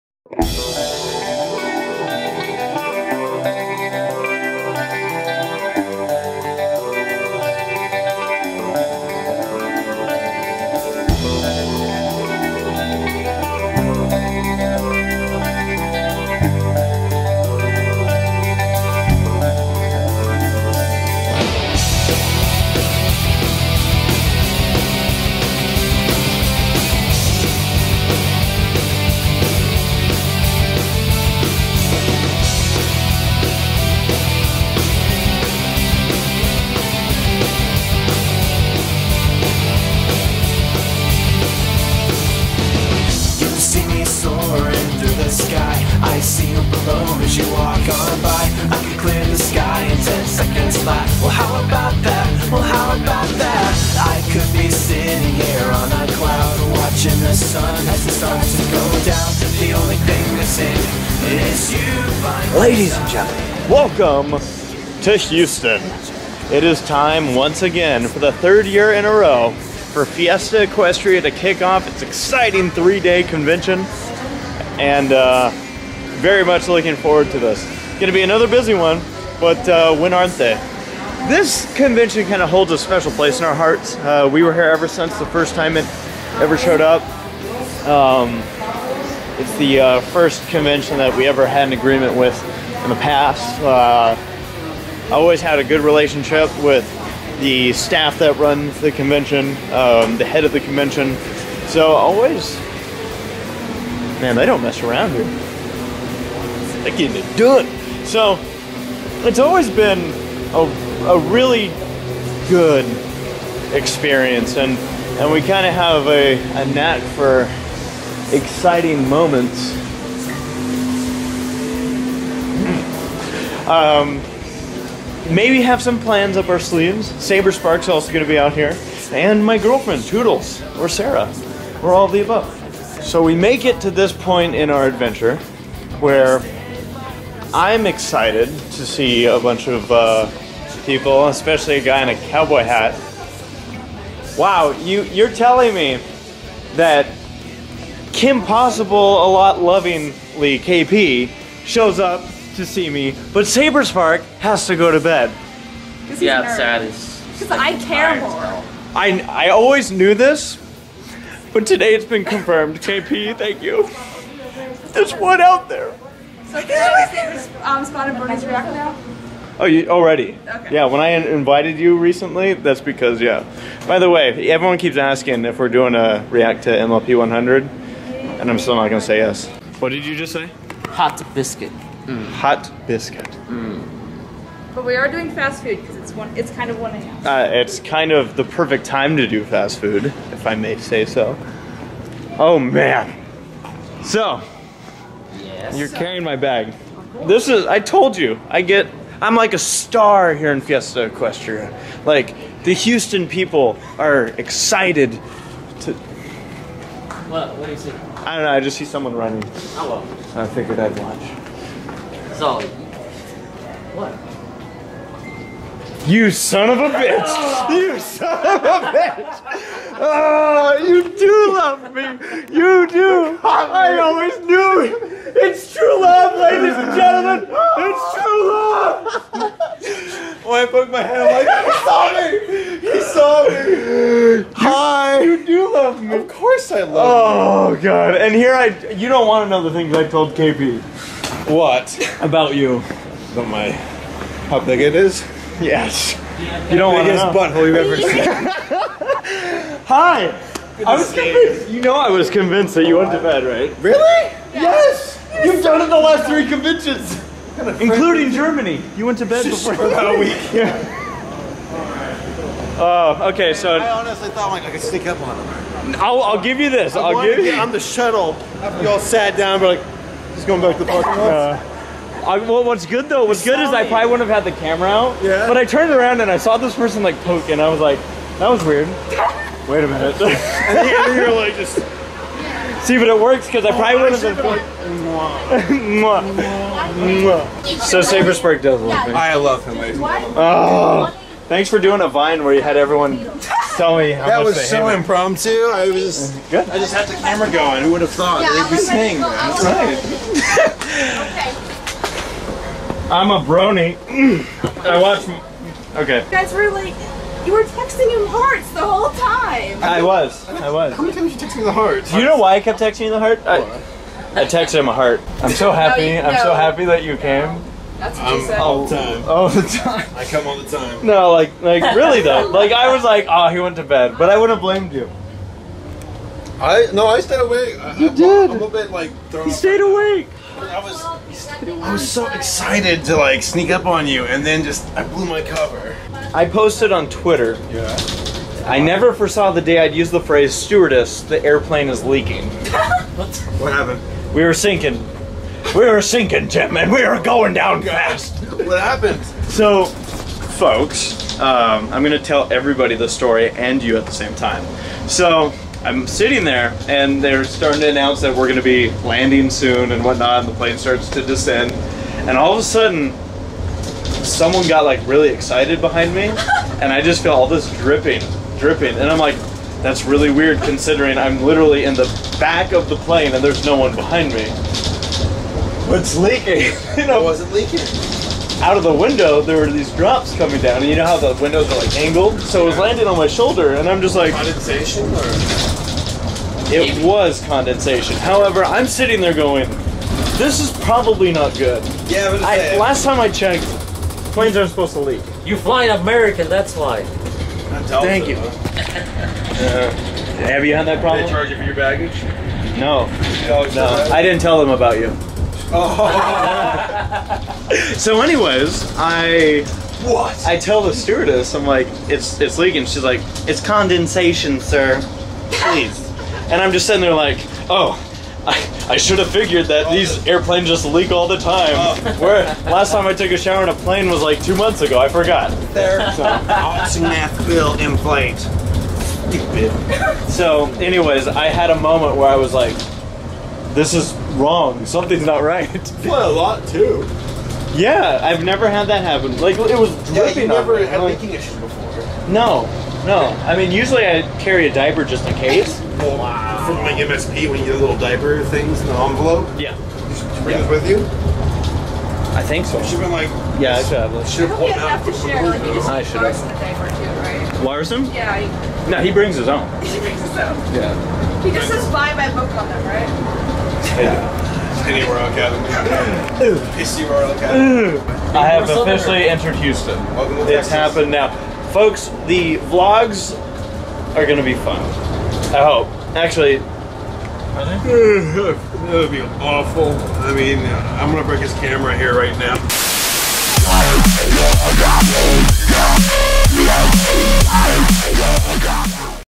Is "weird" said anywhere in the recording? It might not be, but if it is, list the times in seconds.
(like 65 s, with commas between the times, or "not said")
278 s, 370 s.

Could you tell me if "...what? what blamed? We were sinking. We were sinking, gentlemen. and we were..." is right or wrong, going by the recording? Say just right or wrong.
wrong.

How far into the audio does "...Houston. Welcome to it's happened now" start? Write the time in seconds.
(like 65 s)
469 s.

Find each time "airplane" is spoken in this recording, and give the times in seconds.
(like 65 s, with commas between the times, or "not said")
341 s, 420 s.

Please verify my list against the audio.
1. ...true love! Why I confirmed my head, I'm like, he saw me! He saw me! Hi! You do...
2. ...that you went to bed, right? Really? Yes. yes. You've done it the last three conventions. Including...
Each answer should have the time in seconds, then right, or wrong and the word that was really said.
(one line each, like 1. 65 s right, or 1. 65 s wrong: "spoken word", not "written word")
1. 228 s wrong: "poked", not "confirmed"
2. 252 s right.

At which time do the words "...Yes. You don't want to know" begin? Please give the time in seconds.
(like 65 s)
245 s.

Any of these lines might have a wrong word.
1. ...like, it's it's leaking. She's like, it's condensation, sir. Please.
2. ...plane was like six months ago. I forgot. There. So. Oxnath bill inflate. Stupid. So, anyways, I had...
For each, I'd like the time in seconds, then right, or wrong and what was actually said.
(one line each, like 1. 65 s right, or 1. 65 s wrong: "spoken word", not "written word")
1. 411 s right
2. 423 s wrong: "two", not "six".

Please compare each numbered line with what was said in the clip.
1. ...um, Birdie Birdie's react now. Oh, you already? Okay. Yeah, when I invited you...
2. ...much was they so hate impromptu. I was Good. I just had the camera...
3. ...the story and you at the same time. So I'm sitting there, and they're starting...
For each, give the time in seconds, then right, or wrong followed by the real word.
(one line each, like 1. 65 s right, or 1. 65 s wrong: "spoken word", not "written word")
1. 167 s wrong: "Spotted", not "Birdie"
2. 294 s right
3. 352 s right.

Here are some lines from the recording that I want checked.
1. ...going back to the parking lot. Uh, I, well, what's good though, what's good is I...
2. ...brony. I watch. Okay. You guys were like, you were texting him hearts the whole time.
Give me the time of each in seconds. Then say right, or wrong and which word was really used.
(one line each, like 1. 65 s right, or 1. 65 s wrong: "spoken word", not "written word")
1. 270 s right
2. 303 s right.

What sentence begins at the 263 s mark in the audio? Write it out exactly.
I honestly thought like, I could sneak up on him.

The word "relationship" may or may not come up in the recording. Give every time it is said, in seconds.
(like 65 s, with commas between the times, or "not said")
95 s.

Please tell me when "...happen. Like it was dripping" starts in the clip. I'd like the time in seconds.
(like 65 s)
439 s.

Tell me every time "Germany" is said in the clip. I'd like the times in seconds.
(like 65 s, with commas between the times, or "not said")
258 s.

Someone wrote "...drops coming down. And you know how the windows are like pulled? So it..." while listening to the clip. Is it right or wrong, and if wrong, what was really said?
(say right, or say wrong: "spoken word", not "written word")
wrong: "angled", not "pulled".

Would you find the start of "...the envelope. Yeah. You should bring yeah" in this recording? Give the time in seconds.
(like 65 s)
448 s.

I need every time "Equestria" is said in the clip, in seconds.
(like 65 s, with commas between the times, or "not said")
70 s, 201 s.